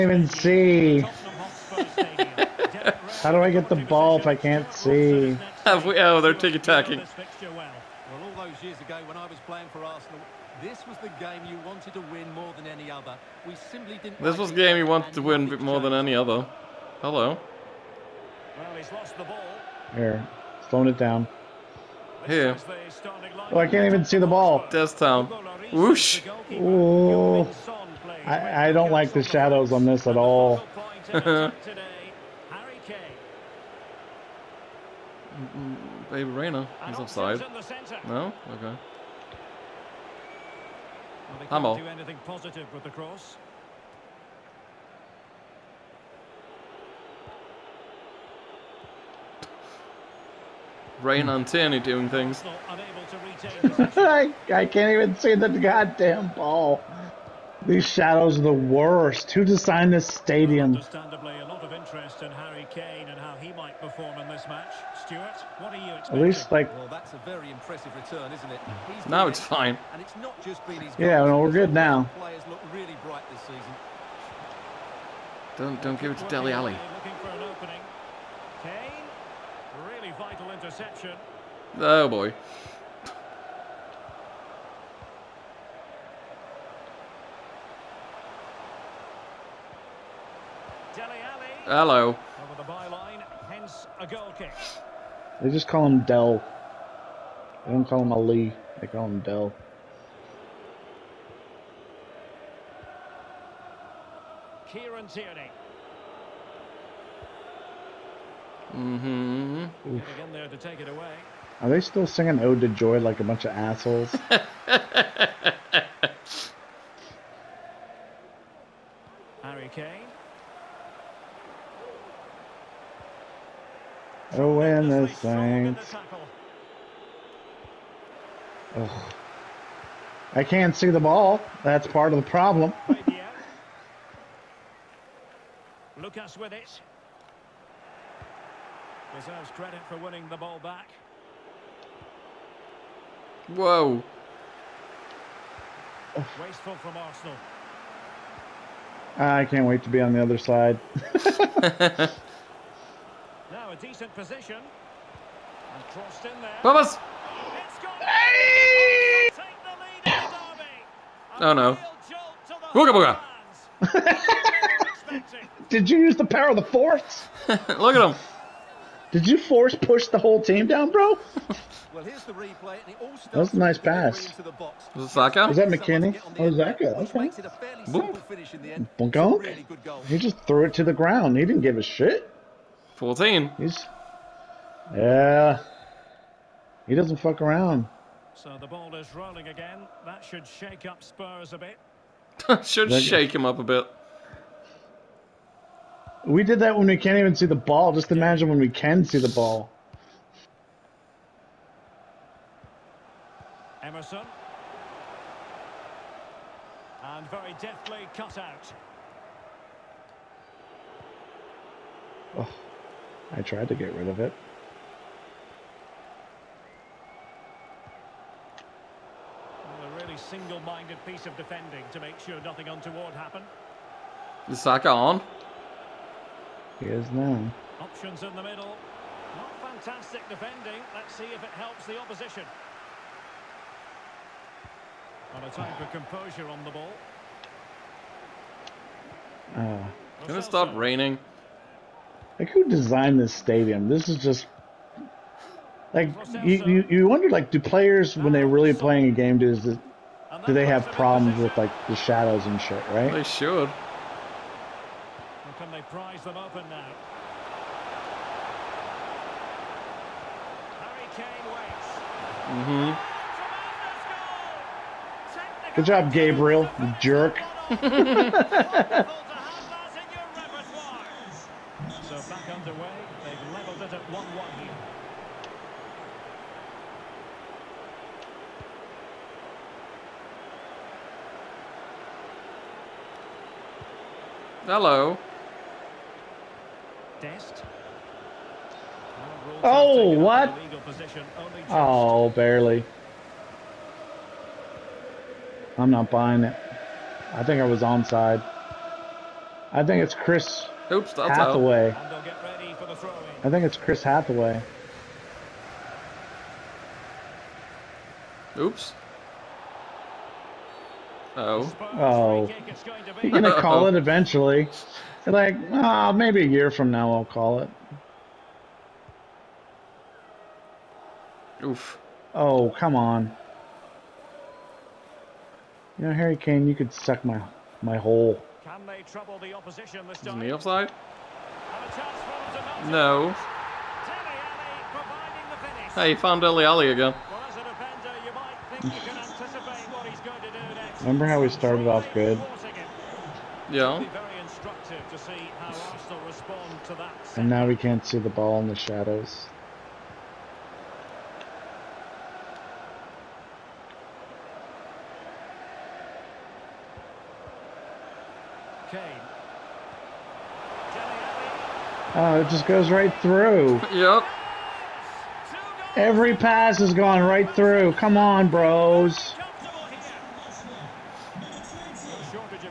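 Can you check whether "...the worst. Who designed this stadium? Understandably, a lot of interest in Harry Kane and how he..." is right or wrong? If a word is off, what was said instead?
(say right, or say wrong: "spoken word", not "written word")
right.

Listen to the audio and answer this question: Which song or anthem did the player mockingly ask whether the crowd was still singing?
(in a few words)
Ode to Joy.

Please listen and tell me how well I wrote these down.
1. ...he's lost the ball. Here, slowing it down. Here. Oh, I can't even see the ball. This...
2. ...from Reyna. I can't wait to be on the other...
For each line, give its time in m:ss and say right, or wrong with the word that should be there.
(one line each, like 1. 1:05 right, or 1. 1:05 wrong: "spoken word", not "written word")
1. 0:18 right
2. 2:26 wrong: "Arsenal", not "Reyna".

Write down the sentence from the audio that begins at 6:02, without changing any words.
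Oh, it just goes right through.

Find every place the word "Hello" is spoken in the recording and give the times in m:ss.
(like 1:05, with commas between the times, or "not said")
0:17, 1:31, 4:44.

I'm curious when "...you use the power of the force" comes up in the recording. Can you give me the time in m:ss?
2:45.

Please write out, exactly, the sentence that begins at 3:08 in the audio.
So the ball is rolling again.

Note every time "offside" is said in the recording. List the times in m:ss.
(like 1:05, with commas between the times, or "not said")
0:36, 5:30.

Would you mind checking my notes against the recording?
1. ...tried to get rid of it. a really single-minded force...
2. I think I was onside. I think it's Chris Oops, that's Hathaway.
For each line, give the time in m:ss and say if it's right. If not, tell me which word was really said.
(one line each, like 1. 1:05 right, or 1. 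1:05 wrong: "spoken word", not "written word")
1. 3:33 wrong: "piece", not "force"
2. 4:57 right.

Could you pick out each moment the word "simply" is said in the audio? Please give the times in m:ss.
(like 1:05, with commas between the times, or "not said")
0:13.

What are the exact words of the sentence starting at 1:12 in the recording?
Players look really bright this season.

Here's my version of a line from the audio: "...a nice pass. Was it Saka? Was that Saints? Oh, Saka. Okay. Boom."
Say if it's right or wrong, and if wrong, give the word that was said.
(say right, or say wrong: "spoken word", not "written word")
wrong: "McKennie", not "Saints".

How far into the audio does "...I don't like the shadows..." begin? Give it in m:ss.
0:28.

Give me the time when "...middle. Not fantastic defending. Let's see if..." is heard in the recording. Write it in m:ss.
3:48.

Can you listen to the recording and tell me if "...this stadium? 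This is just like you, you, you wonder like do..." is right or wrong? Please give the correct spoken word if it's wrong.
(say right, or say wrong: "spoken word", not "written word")
right.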